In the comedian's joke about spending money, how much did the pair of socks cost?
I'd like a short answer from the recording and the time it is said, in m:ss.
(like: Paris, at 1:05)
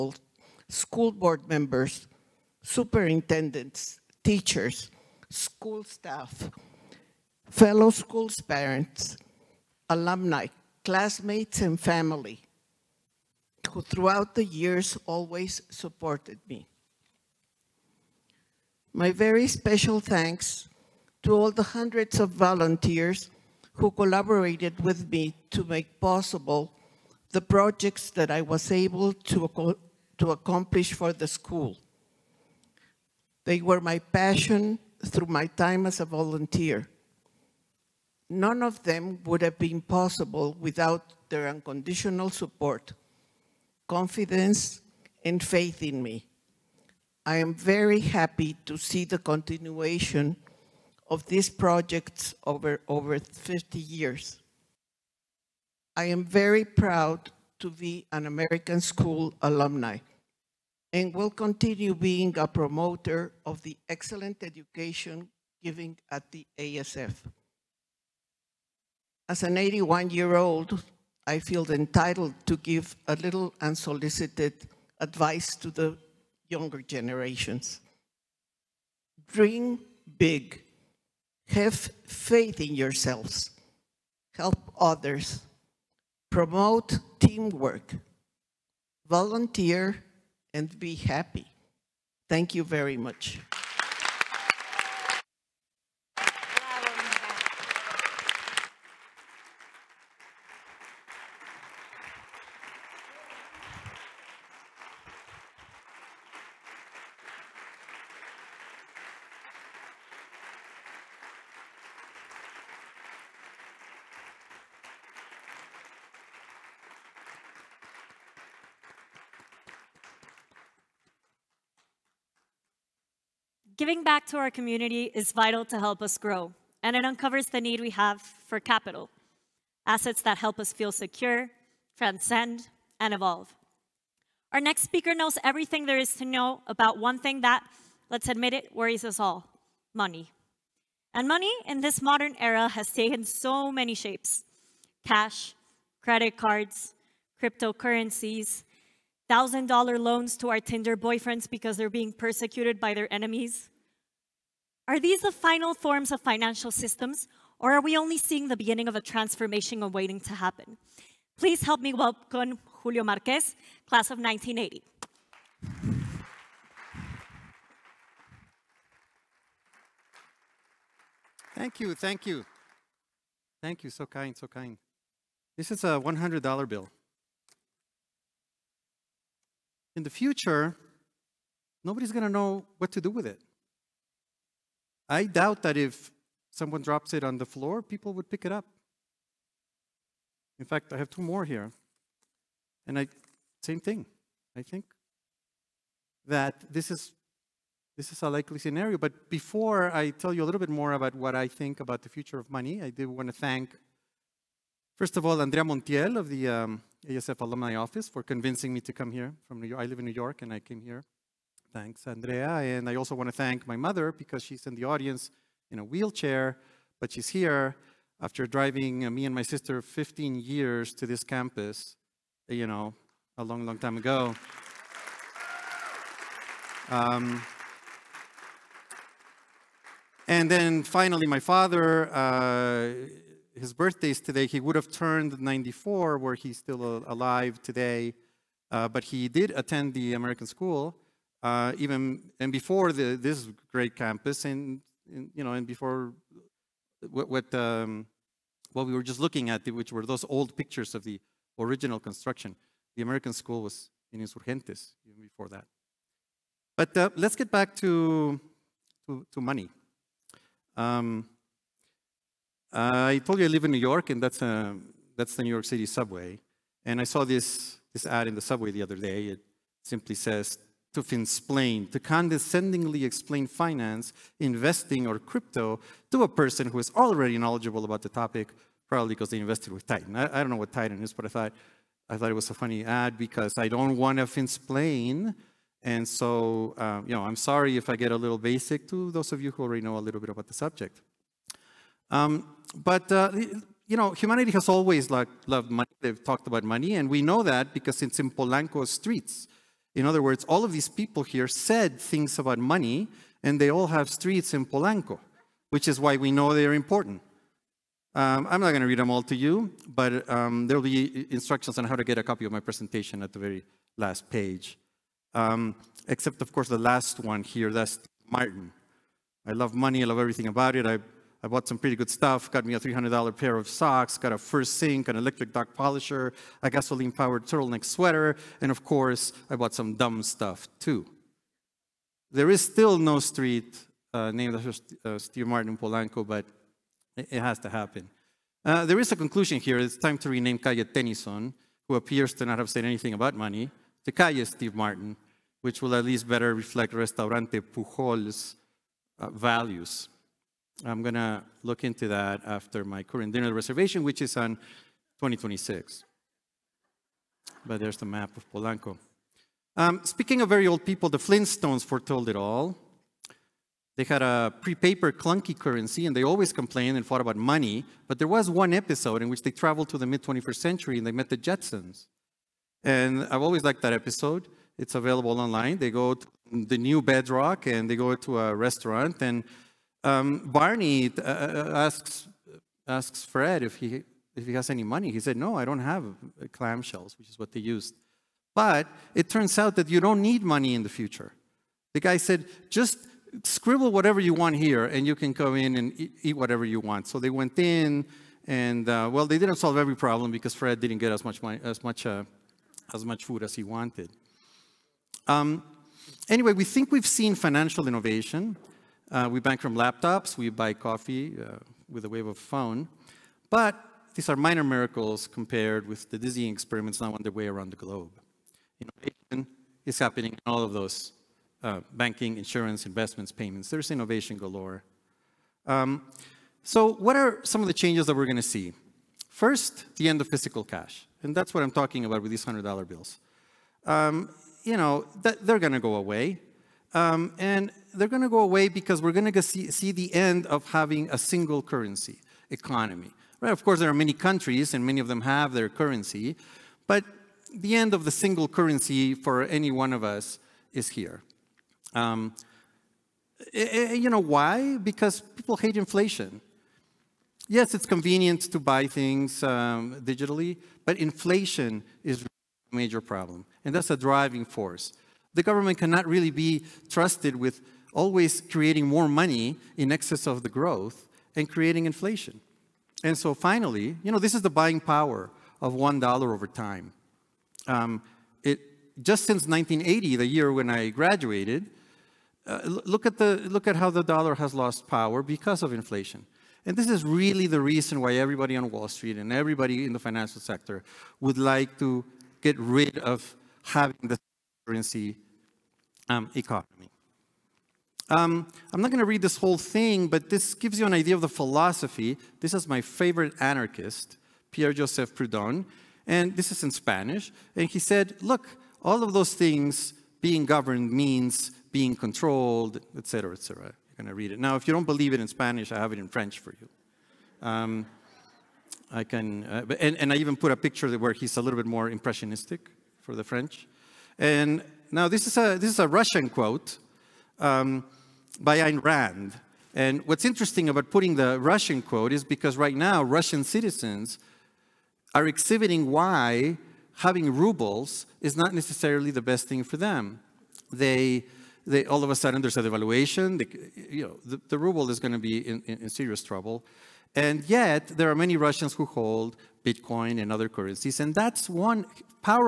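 $300, at 5:22.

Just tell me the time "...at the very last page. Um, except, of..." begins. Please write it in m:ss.
5:13.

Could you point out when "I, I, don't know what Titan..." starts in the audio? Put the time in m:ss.
4:40.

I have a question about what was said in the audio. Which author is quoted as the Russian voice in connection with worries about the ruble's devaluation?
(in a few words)
Ayn Rand.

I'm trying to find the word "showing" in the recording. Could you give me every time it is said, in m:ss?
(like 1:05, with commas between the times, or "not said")
not said.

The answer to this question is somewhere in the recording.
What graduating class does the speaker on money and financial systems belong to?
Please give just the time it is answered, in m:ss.
2:43.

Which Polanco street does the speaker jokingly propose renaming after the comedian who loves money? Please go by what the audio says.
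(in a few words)
Calle Tennyson.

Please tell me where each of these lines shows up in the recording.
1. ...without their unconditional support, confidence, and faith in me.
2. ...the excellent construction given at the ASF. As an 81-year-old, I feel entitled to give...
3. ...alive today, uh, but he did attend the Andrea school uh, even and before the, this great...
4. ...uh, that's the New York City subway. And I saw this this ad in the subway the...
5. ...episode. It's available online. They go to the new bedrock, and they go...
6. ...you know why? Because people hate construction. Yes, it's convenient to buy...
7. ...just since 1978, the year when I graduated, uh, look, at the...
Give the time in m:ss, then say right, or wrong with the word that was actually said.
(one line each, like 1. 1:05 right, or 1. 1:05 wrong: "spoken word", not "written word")
1. 0:40 right
2. 1:03 wrong: "education", not "construction"
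3. 3:57 wrong: "American", not "Andrea"
4. 4:24 right
5. 6:13 right
6. 7:33 wrong: "inflation", not "construction"
7. 7:59 wrong: "1980", not "1978".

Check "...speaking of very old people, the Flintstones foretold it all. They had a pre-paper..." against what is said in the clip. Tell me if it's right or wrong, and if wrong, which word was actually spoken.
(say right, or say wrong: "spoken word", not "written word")
right.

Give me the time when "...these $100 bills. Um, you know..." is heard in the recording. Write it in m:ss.
7:12.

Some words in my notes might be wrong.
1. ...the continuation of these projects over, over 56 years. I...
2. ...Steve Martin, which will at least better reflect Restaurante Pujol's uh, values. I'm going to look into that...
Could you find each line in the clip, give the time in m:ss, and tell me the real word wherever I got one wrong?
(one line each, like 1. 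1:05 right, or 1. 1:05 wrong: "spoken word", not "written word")
1. 0:49 wrong: "50", not "56"
2. 5:44 right.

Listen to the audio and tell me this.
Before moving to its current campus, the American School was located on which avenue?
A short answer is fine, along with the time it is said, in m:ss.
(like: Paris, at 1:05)
Insurgentes, at 4:14.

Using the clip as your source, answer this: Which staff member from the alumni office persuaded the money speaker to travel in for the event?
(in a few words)
Andrea Montiel.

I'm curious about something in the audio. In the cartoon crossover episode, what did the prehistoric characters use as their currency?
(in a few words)
clamshells.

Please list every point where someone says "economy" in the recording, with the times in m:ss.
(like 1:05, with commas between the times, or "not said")
7:22, 8:16.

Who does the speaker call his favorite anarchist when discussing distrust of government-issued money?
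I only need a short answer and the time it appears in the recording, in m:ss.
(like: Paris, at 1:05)
Pierre Joseph Proudhon, at 8:24.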